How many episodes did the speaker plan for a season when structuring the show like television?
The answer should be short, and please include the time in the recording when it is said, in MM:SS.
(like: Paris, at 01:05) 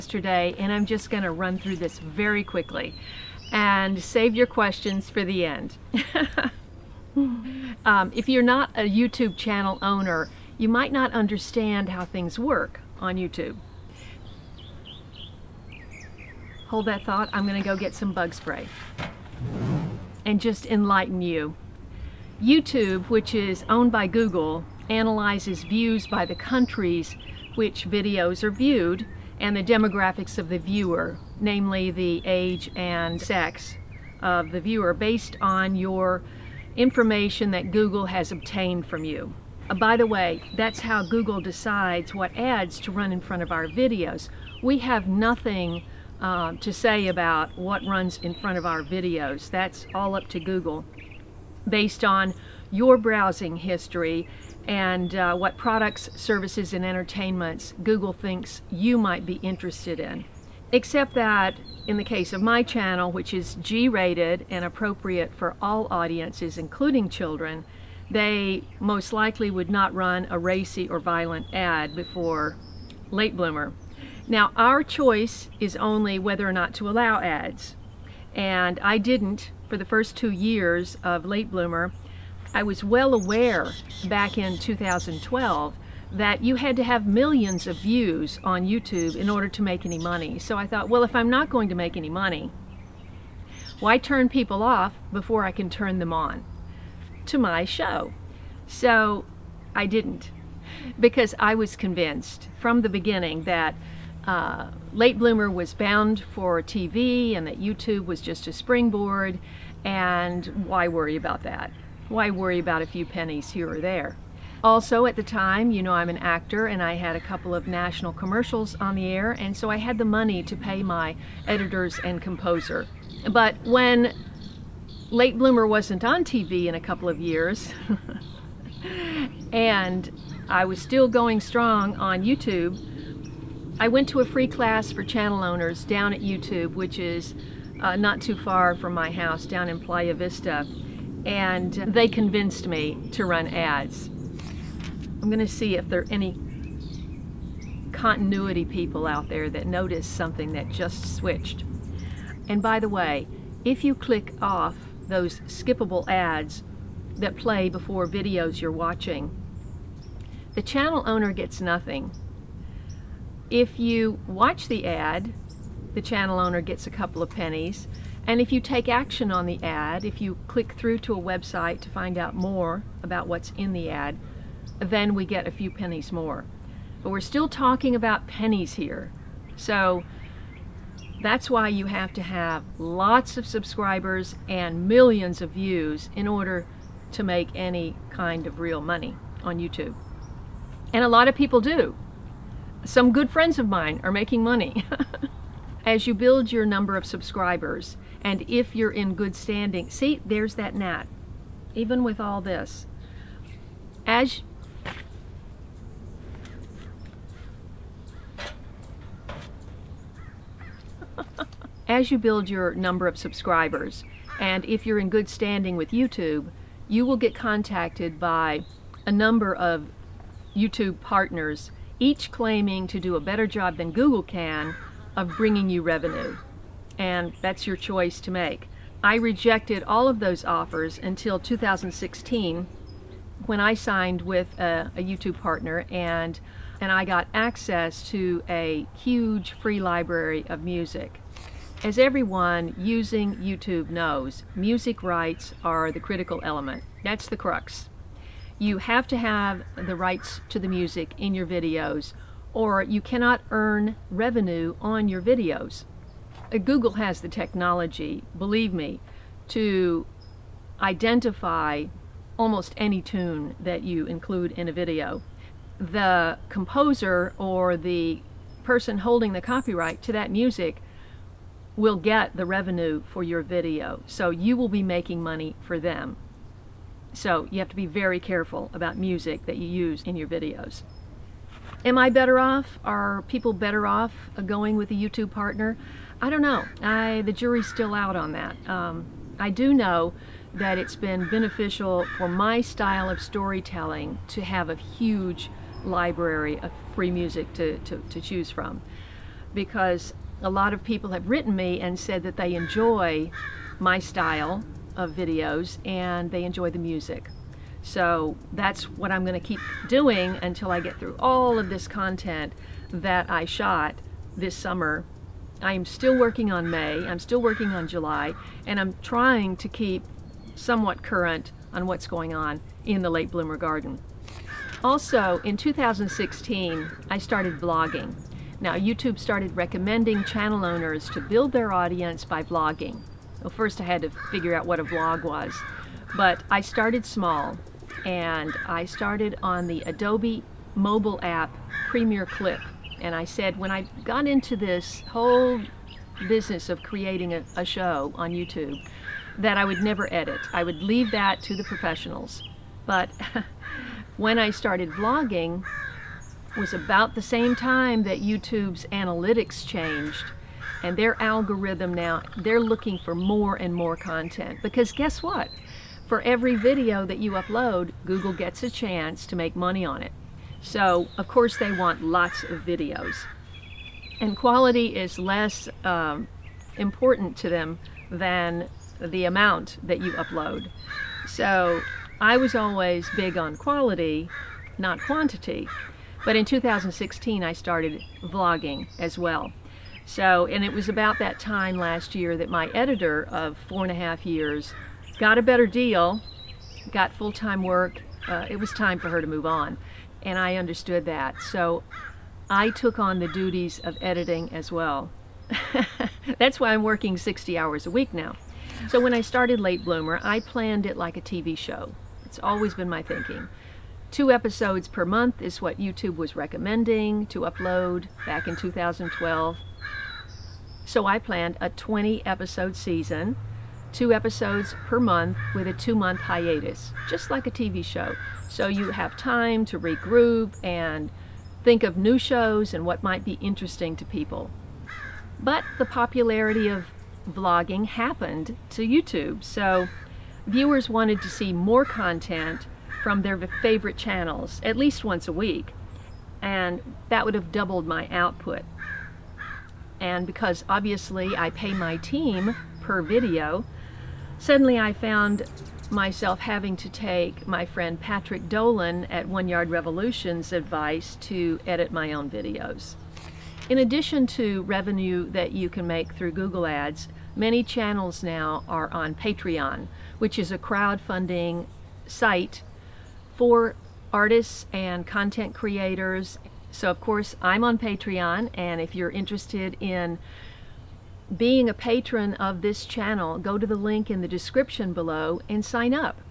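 20, at 07:01.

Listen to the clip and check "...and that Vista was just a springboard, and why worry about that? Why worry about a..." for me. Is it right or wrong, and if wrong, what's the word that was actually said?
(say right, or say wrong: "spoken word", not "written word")
wrong: "YouTube", not "Vista".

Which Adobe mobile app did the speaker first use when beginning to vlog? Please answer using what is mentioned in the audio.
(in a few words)
Premiere Clip.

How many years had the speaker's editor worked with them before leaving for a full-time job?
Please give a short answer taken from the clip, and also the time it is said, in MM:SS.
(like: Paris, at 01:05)
4 and a half years, at 06:33.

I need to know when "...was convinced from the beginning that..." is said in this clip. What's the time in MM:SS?
01:41.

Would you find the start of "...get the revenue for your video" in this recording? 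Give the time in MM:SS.
04:31.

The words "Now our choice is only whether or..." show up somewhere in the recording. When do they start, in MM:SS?
01:14.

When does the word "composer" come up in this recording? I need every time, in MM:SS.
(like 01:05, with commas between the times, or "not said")
02:02, 04:26.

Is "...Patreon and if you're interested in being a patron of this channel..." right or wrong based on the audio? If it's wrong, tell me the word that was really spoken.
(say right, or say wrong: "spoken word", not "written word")
right.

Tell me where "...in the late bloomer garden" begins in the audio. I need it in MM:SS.
05:22.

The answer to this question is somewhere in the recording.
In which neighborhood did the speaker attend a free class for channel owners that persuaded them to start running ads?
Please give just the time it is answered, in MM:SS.
02:19.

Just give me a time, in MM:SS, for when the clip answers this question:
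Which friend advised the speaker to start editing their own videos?
07:38.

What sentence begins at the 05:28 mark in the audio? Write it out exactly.
Now, YouTube started recommending channel owners to build their audience by vlogging.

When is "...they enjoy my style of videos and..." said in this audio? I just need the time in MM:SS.
05:02.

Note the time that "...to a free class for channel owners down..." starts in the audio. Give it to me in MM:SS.
02:14.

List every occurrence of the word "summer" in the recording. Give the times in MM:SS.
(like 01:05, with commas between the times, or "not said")
05:14.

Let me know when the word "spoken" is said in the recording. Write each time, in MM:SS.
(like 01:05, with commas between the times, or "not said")
not said.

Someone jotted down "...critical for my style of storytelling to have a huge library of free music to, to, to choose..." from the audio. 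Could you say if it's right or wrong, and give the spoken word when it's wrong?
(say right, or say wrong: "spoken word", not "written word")
wrong: "beneficial", not "critical".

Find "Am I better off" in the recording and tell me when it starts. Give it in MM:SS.
04:41.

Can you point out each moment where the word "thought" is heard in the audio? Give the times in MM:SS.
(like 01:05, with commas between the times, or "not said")
00:17, 01:30.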